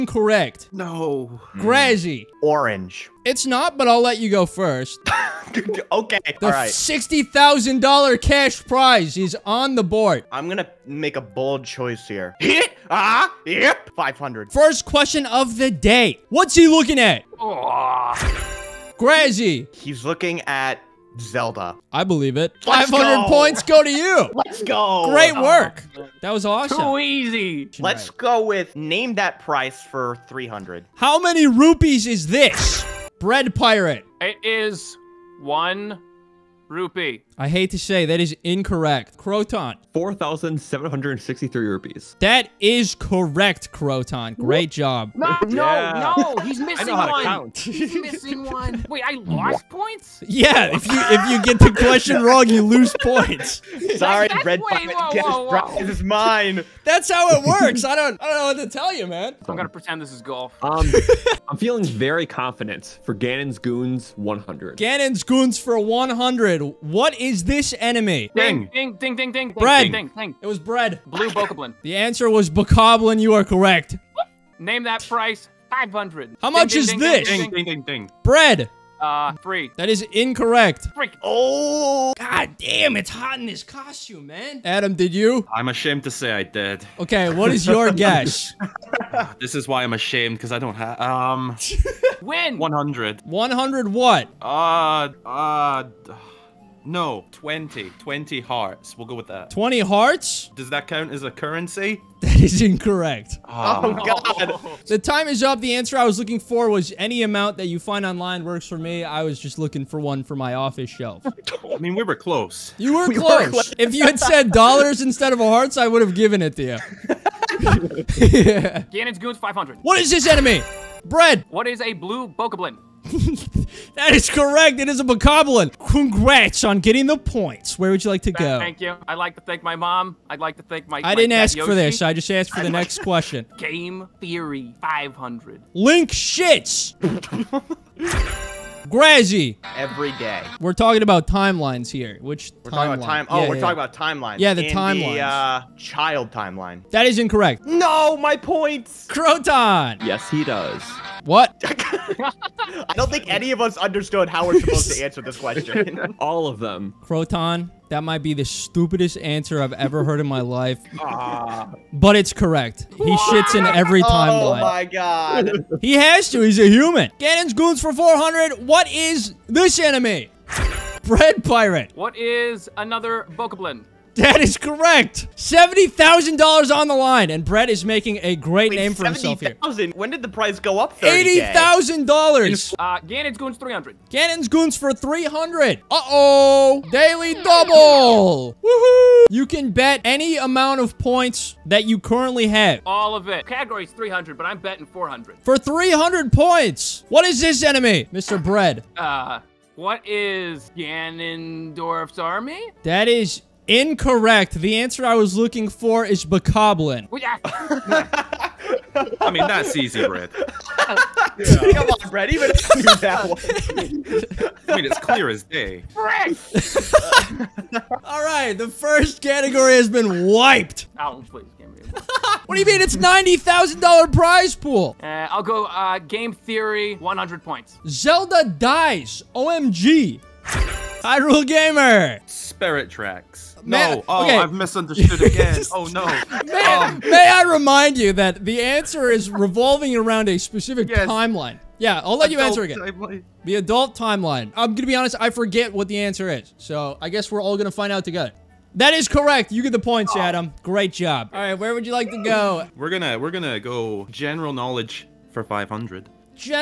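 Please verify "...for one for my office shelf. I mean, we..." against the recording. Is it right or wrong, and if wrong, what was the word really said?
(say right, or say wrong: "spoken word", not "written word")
right.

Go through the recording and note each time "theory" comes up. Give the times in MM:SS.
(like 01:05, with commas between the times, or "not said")
02:14, 03:46.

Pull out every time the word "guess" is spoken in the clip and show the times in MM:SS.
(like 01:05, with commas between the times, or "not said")
01:27, 04:07.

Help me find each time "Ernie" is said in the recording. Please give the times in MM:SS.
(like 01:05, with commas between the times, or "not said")
not said.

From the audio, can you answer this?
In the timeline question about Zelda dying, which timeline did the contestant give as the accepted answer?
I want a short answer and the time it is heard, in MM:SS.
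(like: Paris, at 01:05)
adult timeline, at 04:03.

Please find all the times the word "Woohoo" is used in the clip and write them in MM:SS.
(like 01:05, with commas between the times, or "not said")
03:08.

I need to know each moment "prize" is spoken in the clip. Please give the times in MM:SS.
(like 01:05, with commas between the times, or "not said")
00:08, 03:44.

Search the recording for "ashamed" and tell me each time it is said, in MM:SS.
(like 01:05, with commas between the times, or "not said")
01:25, 01:29.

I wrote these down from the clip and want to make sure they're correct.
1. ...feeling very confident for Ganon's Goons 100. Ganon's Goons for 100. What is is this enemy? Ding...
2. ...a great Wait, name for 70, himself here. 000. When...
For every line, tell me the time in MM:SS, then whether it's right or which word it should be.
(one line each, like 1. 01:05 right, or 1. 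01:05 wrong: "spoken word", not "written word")
1. 01:01 right
2. 02:58 right.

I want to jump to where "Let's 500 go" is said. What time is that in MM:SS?
00:22.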